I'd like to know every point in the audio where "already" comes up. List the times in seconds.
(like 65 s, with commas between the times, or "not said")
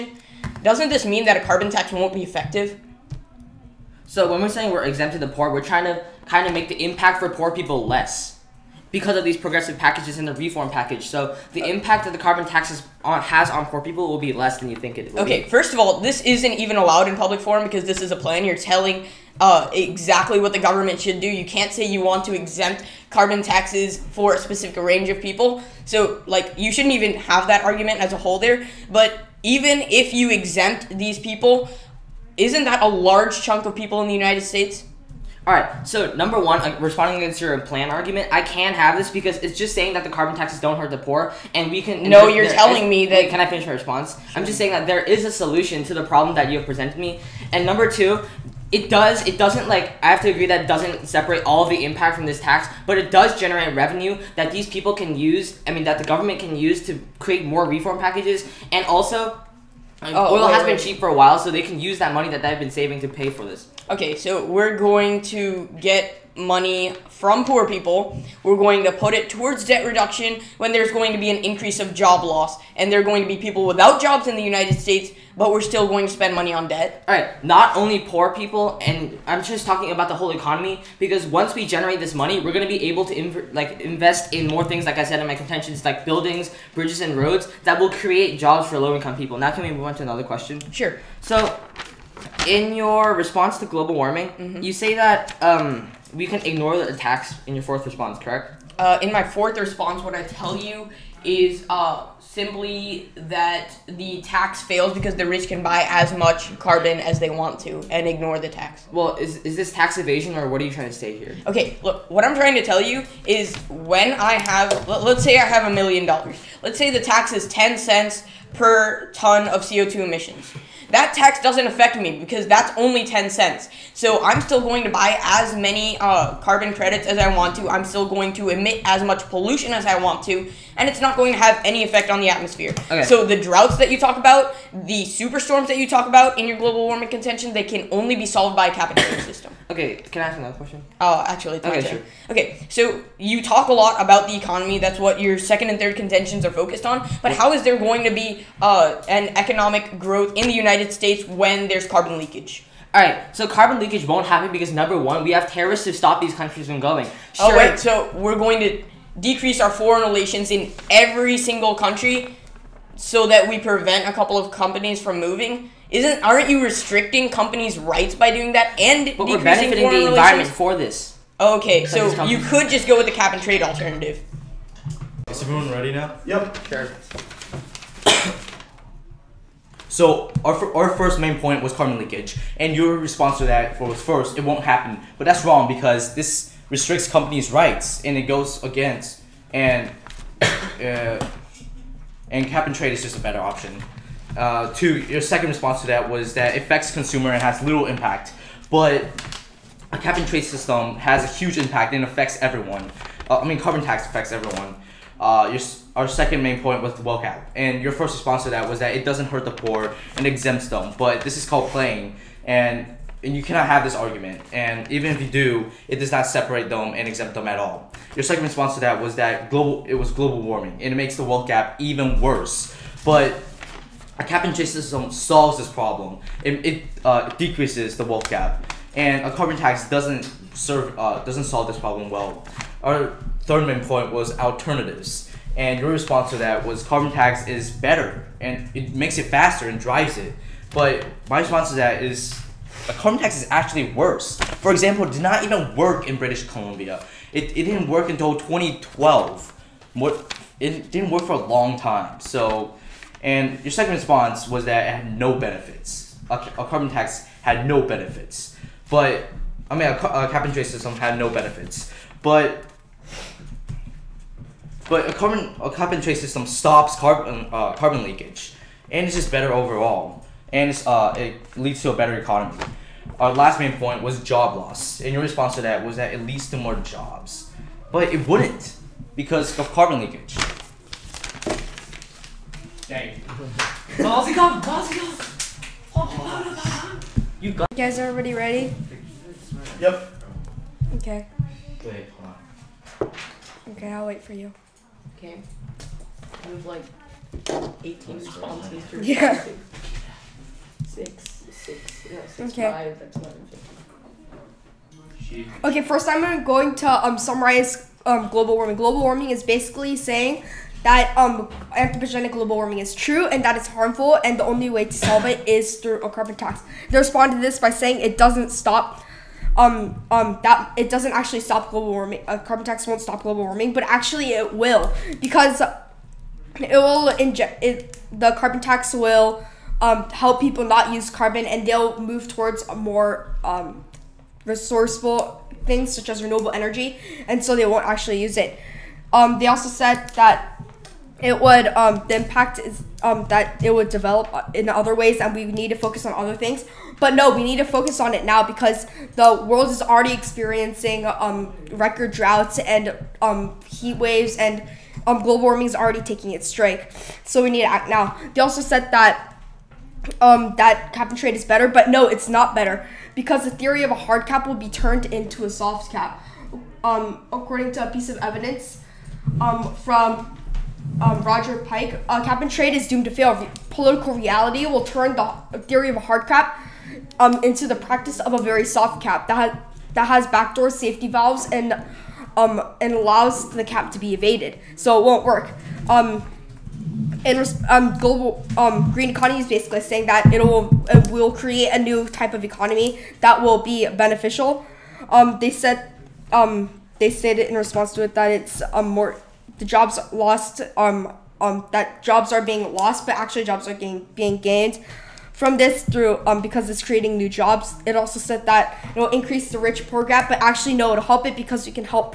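349 s, 355 s.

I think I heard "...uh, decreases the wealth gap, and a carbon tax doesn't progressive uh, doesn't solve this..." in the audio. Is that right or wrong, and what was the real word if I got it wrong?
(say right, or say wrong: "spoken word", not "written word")
wrong: "serve", not "progressive".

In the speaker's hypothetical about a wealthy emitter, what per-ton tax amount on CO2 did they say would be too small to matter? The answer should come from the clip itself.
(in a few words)
10 cents.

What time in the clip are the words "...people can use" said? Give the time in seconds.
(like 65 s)
54 s.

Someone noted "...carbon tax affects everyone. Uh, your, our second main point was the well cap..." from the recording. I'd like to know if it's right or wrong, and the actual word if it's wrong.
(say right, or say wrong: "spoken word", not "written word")
right.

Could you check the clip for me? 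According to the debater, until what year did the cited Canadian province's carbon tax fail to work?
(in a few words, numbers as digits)
2012.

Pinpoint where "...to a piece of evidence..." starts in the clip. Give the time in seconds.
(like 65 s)
367 s.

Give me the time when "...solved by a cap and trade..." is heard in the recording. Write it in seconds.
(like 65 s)
138 s.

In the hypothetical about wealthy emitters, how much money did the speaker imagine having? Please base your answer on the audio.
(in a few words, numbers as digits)
a million dollars.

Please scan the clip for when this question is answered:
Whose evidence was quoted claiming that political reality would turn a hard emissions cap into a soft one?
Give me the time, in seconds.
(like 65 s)
371 s.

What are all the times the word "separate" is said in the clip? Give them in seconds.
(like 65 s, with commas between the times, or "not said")
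51 s, 216 s.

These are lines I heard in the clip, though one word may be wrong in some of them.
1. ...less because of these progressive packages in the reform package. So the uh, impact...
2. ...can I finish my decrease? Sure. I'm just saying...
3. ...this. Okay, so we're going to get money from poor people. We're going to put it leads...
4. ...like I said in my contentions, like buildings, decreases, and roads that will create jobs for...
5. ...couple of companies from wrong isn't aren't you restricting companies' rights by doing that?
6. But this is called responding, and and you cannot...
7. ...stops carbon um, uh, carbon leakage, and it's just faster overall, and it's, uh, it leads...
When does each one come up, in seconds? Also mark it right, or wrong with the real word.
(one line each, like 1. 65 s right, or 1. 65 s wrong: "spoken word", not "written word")
1. 7 s right
2. 43 s wrong: "response", not "decrease"
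3. 63 s wrong: "towards", not "leads"
4. 84 s wrong: "bridges", not "decreases"
5. 164 s wrong: "moving", not "wrong"
6. 210 s wrong: "playing", not "responding"
7. 266 s wrong: "better", not "faster".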